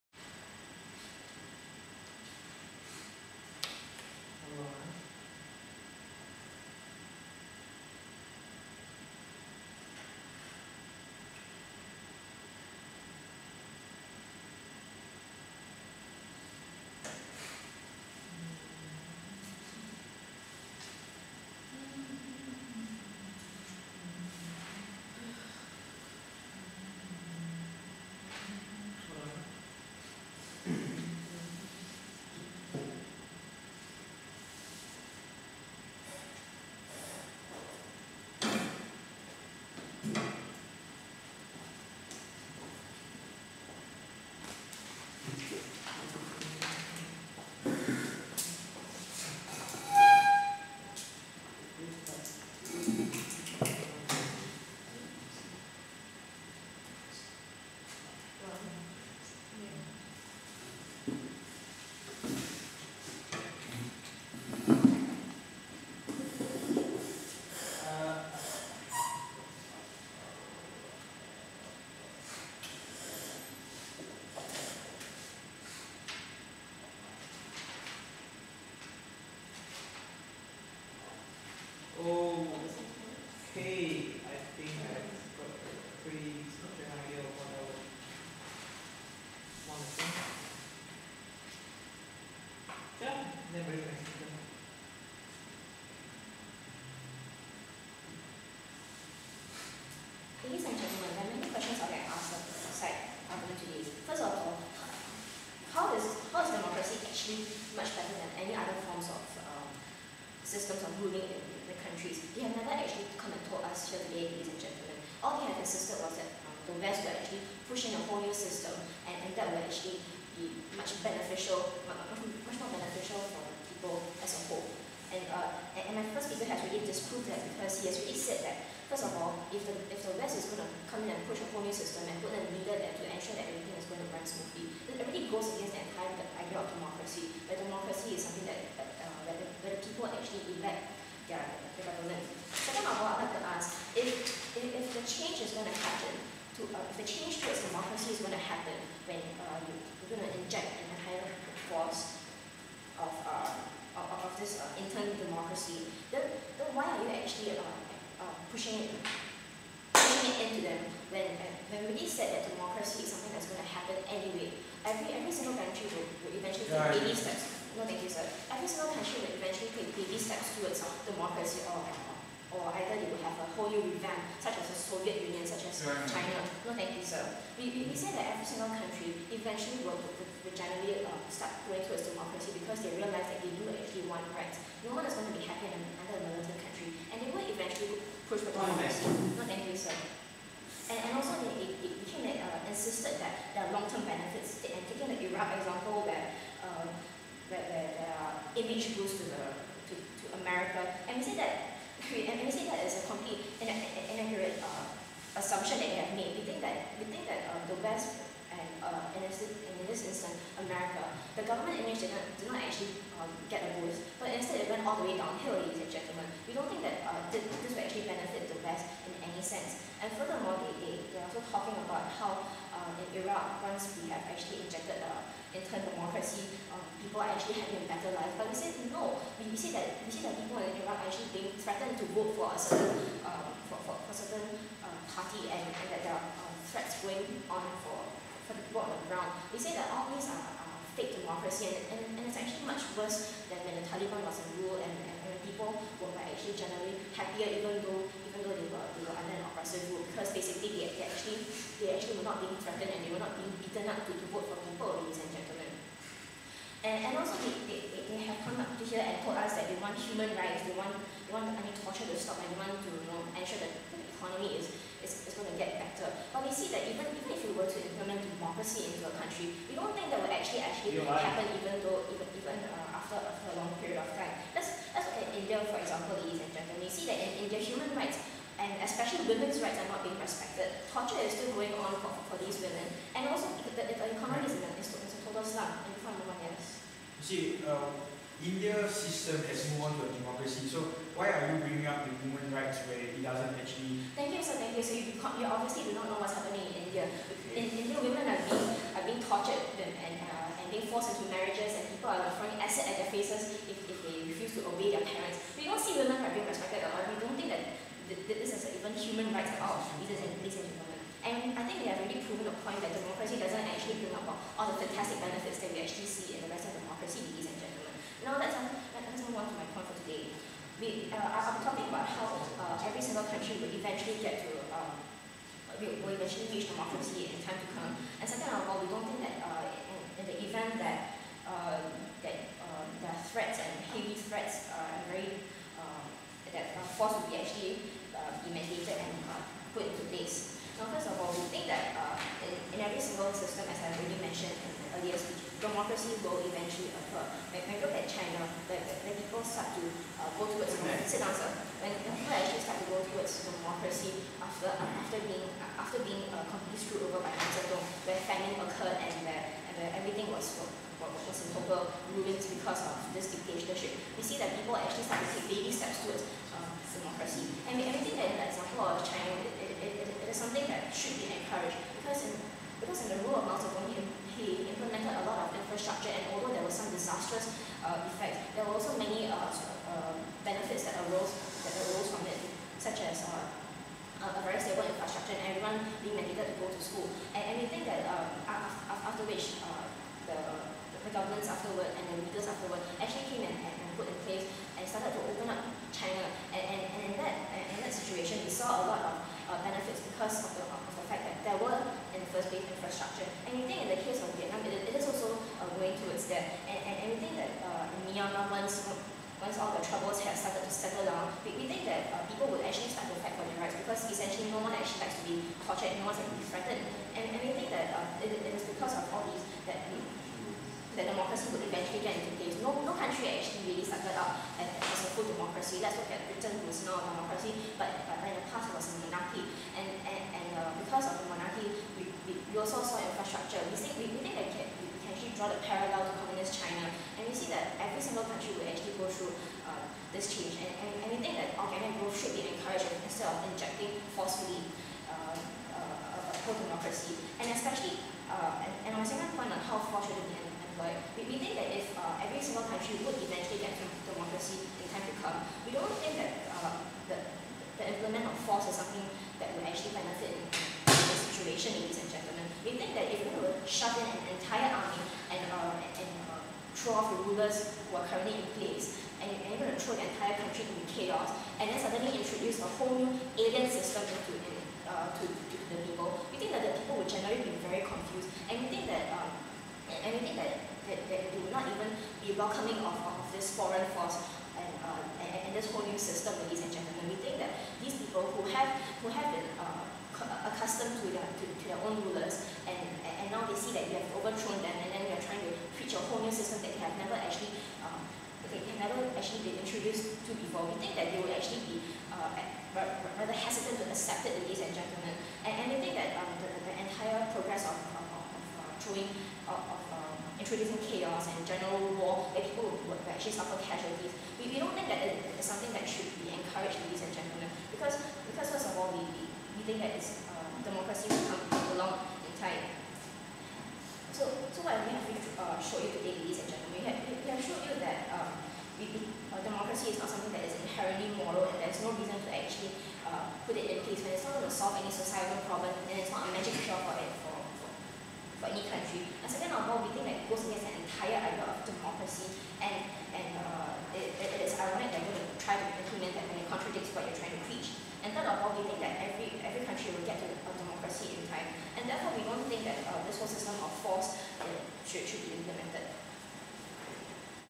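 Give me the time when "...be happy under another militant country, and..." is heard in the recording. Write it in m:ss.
3:05.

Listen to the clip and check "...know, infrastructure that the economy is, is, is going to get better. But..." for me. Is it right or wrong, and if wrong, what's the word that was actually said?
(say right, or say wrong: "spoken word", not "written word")
wrong: "ensure", not "infrastructure".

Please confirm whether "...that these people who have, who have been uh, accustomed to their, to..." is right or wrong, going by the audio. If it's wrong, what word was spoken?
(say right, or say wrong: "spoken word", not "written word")
right.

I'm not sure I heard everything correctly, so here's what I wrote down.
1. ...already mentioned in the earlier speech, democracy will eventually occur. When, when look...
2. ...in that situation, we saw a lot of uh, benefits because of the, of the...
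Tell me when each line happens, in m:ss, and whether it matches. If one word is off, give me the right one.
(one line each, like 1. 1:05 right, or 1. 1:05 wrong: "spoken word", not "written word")
1. 5:43 right
2. 6:37 right.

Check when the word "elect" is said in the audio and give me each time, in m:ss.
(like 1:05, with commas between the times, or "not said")
2:20.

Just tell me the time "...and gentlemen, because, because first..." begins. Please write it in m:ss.
8:37.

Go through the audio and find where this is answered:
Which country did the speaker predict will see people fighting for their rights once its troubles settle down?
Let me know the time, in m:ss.
6:48.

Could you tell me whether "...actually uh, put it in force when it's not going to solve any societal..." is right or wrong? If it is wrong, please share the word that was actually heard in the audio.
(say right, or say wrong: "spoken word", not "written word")
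wrong: "place", not "force".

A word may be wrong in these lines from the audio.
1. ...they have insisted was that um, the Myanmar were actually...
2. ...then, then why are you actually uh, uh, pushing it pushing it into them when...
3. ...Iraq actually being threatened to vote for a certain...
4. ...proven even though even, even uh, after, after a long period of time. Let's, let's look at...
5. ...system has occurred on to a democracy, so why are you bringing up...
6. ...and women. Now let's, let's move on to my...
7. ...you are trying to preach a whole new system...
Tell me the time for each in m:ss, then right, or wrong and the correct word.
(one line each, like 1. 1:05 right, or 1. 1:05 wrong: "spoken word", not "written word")
1. 1:55 wrong: "West", not "Myanmar"
2. 2:36 right
3. 3:50 right
4. 4:31 wrong: "happen", not "proven"
5. 4:48 wrong: "moved", not "occurred"
6. 5:17 wrong: "gentlemen", not "women"
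7. 8:15 right.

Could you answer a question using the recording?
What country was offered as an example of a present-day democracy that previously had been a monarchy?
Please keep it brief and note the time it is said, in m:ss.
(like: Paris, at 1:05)
Britain, at 7:06.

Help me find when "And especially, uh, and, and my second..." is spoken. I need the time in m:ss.
7:27.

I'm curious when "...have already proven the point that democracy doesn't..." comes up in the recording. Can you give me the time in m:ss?
5:11.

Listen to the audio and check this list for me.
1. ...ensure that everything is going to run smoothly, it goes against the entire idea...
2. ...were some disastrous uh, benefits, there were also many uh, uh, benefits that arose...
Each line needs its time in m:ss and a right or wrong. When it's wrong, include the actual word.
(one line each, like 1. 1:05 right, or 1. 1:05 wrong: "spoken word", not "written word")
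1. 2:13 right
2. 6:16 wrong: "effects", not "benefits".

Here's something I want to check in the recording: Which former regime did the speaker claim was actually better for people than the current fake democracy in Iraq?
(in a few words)
The Taliban.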